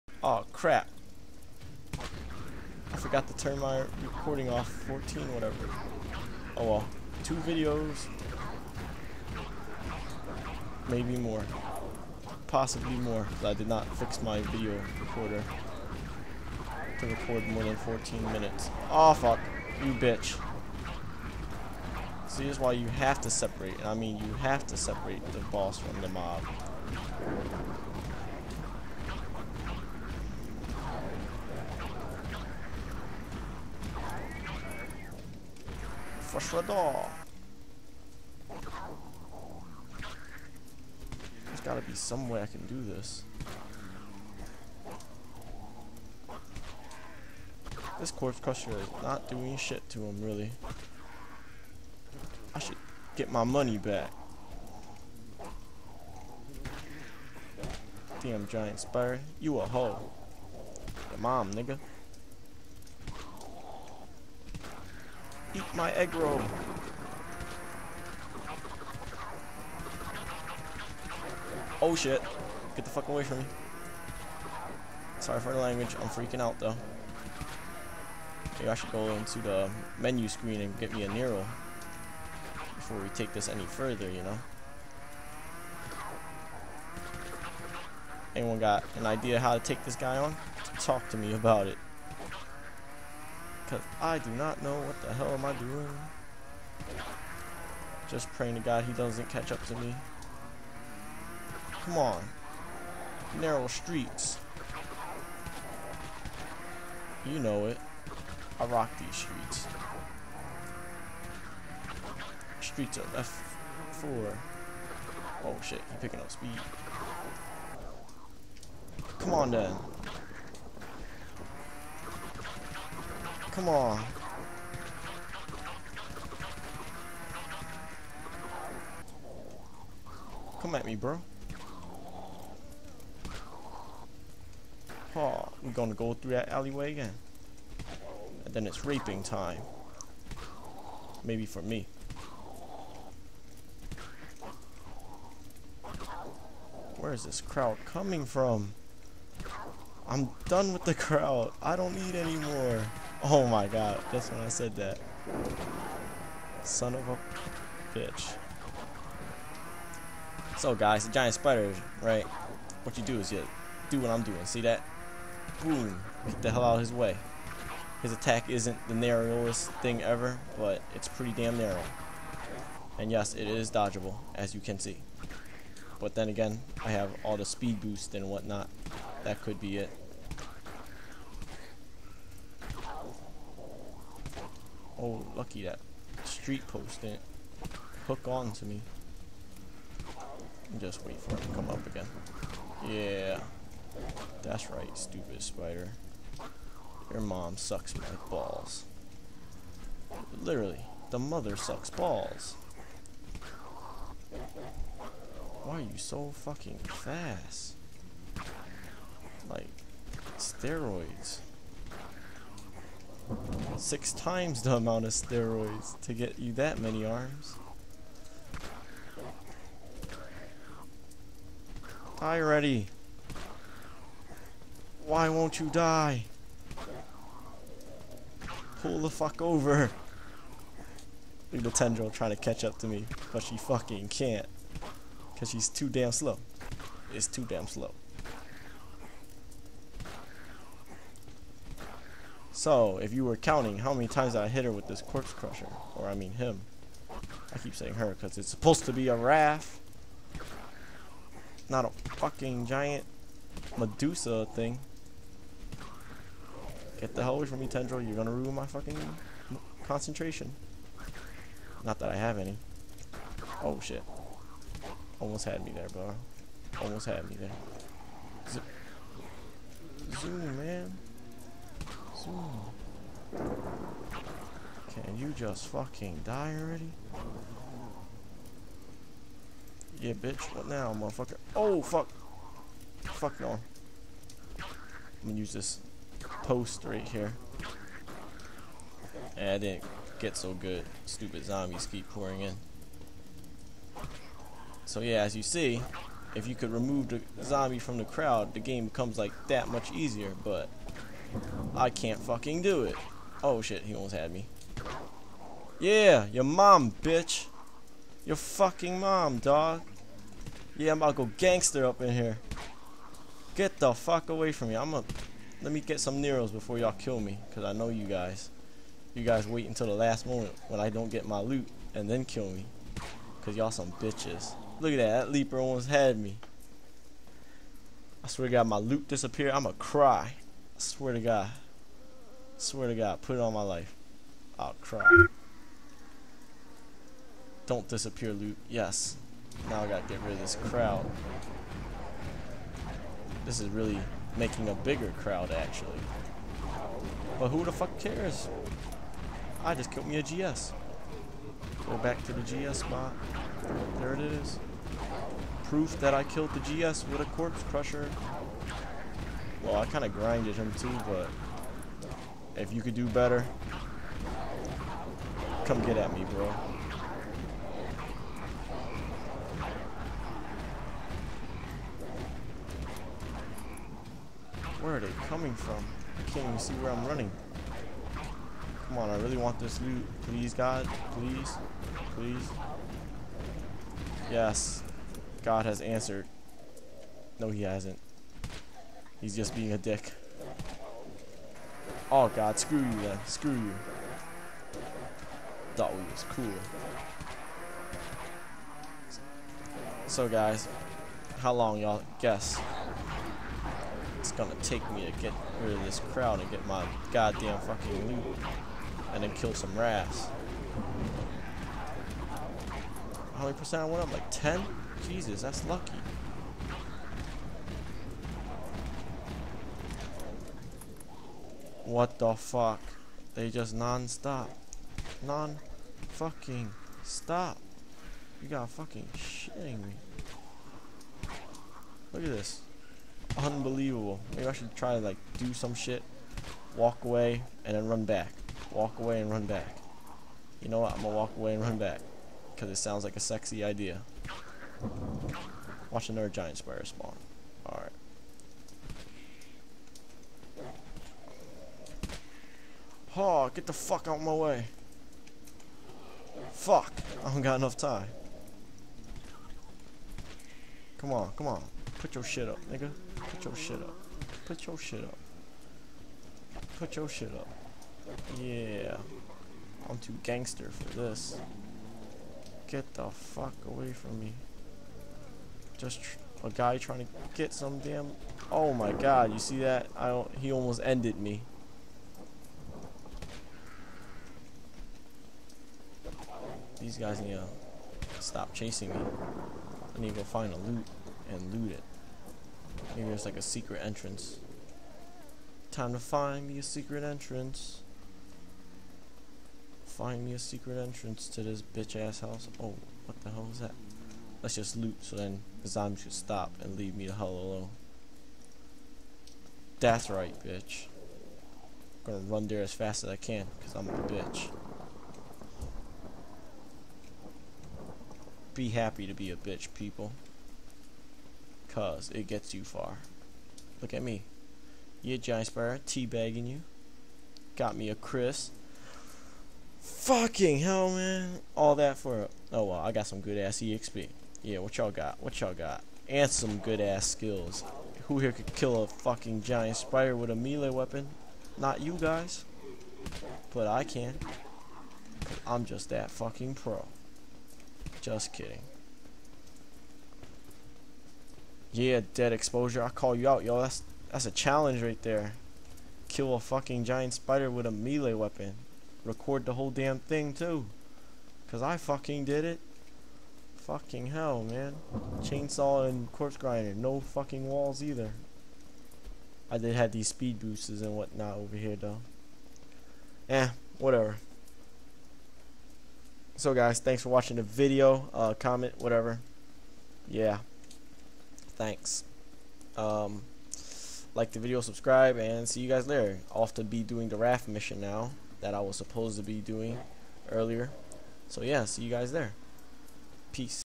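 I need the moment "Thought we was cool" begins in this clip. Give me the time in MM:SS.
06:35.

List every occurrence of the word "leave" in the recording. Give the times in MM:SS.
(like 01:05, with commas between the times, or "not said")
08:26.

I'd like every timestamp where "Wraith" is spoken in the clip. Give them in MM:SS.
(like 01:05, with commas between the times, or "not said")
04:09, 09:47.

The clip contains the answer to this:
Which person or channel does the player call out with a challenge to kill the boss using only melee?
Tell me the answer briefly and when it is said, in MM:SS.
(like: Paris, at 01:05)
dead exposure, at 09:12.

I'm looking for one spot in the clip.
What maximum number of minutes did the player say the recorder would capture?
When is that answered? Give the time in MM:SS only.
00:17.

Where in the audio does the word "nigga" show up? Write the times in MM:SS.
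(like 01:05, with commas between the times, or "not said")
01:01, 07:42.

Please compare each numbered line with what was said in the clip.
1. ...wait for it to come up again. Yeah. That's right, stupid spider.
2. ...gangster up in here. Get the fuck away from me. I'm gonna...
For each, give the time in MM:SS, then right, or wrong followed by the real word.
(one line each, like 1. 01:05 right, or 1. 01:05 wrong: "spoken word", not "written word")
1. 03:11 right
2. 05:11 right.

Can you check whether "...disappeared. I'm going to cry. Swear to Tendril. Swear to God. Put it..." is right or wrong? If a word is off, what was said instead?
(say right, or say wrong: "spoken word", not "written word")
wrong: "God", not "Tendril".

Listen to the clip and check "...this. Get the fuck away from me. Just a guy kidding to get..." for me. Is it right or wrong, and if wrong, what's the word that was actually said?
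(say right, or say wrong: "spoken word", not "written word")
wrong: "trying", not "kidding".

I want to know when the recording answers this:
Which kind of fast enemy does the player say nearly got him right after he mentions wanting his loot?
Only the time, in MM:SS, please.
05:25.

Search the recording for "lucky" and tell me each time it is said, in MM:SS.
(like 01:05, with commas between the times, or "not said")
03:05, 06:55.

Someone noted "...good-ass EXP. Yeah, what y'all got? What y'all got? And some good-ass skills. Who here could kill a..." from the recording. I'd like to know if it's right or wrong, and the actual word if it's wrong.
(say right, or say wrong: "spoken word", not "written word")
right.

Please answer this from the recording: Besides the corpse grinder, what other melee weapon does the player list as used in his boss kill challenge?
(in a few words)
Chainsaw.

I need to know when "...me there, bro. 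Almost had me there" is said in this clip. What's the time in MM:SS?
04:25.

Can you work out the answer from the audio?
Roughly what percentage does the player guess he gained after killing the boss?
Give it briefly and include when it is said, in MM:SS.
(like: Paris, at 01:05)
10, at 06:54.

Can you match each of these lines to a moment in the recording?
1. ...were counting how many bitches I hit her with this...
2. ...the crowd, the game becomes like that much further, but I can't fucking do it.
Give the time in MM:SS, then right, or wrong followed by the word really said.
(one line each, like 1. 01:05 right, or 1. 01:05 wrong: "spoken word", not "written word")
1. 04:03 wrong: "times", not "bitches"
2. 04:57 wrong: "easier", not "further".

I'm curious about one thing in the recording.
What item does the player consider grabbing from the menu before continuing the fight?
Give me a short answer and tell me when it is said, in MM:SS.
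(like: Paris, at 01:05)
Nero, at 01:21.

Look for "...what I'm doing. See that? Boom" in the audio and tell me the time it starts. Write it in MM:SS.
02:43.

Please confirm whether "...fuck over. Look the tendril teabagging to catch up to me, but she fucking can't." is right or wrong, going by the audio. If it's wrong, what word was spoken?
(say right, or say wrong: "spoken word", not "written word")
wrong: "trying", not "teabagging".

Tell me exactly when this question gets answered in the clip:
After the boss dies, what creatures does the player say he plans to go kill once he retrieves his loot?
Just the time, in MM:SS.
06:49.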